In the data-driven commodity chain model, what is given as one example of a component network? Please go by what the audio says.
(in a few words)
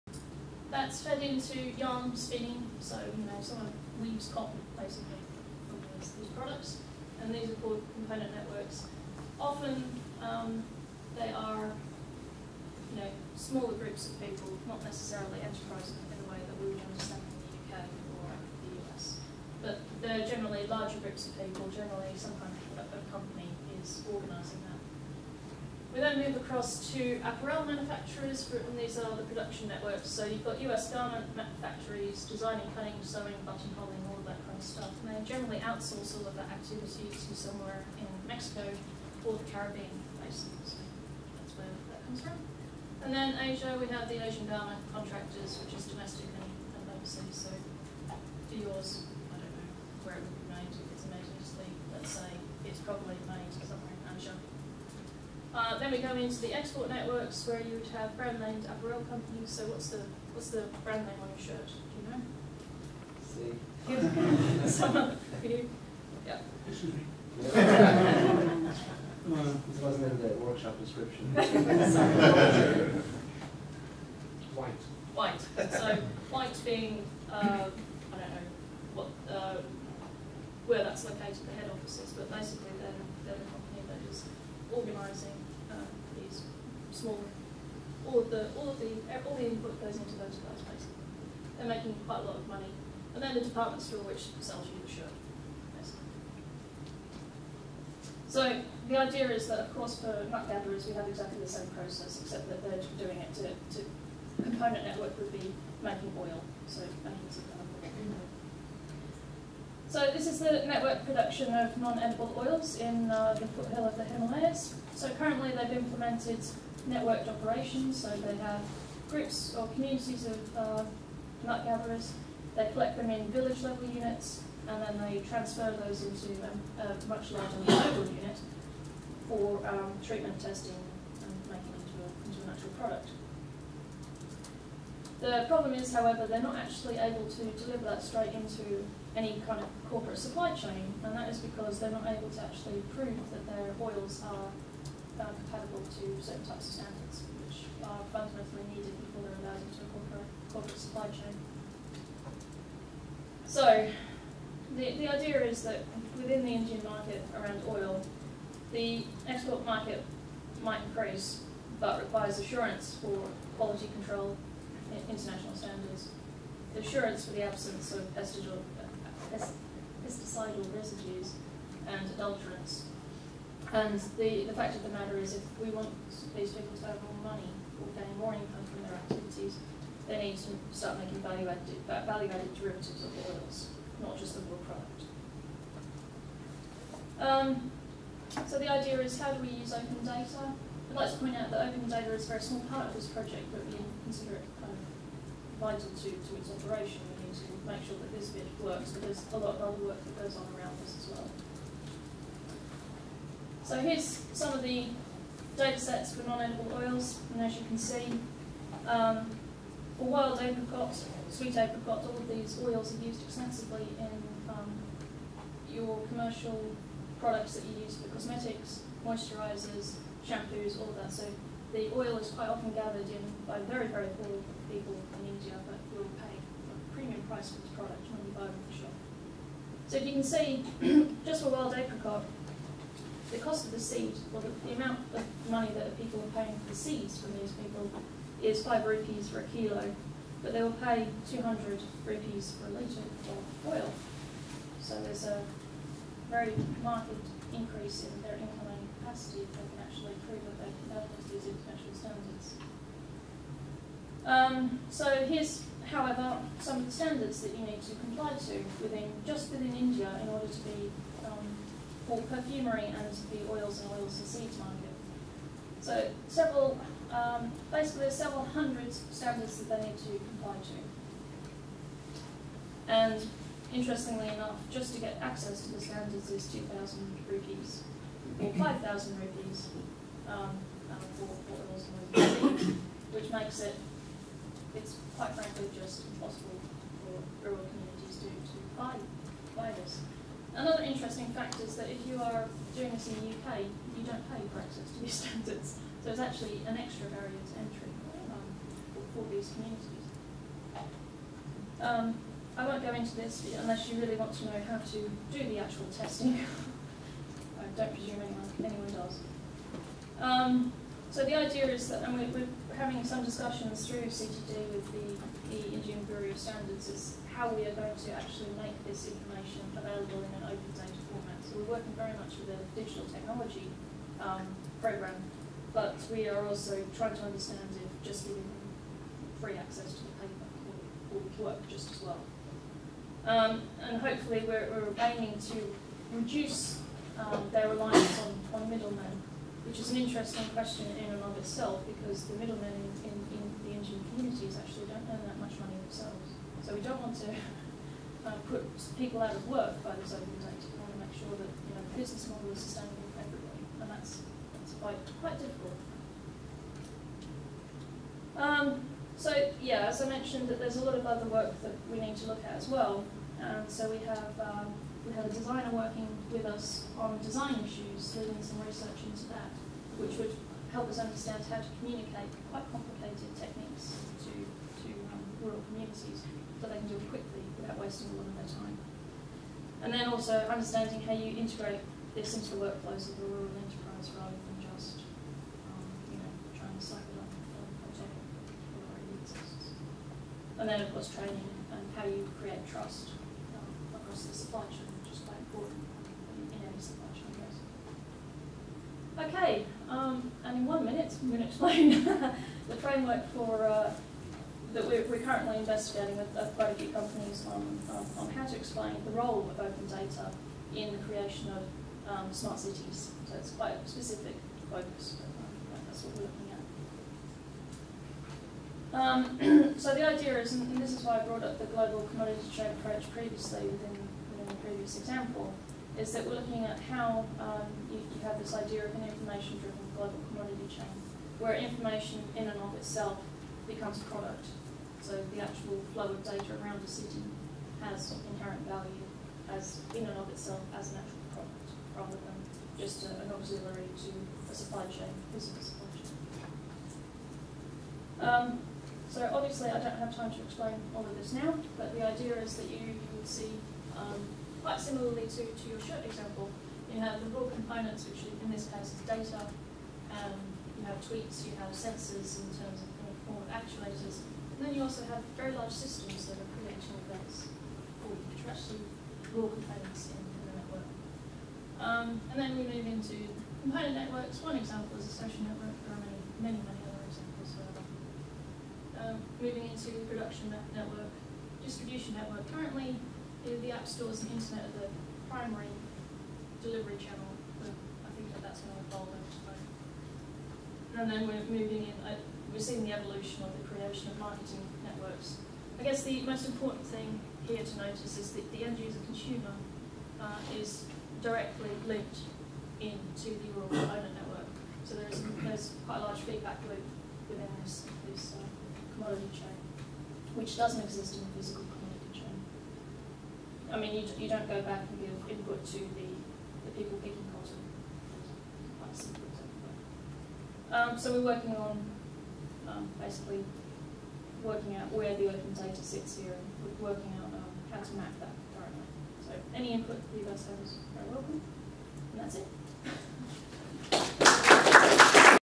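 social network.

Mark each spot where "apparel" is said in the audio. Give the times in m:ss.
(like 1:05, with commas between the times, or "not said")
0:27, 0:58.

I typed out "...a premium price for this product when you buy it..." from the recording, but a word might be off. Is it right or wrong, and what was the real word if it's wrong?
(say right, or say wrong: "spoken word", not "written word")
right.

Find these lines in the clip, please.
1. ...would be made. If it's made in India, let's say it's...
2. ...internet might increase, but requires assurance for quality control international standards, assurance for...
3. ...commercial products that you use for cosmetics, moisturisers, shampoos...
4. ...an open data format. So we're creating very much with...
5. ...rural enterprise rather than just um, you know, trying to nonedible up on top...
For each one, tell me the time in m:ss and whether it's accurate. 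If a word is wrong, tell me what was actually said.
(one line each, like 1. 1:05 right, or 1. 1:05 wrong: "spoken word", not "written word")
1. 0:50 wrong: "Italy", not "India"
2. 2:39 wrong: "market", not "internet"
3. 3:36 right
4. 5:20 wrong: "working", not "creating"
5. 6:23 wrong: "cycle", not "nonedible".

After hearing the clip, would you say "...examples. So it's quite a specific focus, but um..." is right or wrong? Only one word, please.
wrong.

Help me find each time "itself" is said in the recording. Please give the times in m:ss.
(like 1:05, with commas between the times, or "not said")
5:41, 7:12, 7:20.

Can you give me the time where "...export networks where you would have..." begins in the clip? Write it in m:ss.
0:56.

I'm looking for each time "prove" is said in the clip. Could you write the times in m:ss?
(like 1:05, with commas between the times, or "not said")
2:22, 4:10.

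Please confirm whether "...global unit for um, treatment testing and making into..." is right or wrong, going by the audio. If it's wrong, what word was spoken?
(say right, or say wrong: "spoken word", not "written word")
right.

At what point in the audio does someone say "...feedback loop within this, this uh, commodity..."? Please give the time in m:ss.
8:26.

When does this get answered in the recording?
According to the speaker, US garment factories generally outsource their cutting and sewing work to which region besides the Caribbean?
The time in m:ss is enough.
0:38.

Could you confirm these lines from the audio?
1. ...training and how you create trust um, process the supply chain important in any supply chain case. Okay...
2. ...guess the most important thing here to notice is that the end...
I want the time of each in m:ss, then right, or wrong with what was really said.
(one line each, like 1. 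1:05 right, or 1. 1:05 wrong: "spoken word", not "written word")
1. 6:31 wrong: "across", not "process"
2. 8:15 right.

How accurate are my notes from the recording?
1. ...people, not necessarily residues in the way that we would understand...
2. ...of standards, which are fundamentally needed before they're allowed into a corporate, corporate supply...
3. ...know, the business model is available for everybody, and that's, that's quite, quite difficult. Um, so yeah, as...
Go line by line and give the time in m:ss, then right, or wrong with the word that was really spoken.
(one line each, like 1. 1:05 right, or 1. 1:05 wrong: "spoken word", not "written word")
1. 0:14 wrong: "enterprises", not "residues"
2. 2:26 right
3. 5:51 wrong: "sustainable", not "available".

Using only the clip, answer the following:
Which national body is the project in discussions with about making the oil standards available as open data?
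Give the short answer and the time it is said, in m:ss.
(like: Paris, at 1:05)
Indian Bureau of Standards, at 5:15.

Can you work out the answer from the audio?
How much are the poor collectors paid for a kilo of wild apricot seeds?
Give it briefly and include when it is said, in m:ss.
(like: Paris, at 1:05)
5 rupees, at 3:58.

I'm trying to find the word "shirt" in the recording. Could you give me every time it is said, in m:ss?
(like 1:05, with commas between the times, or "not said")
1:01, 1:34, 7:35.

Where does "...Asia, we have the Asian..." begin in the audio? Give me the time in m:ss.
0:43.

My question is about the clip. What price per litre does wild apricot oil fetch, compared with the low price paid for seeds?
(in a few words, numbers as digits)
200 rupees.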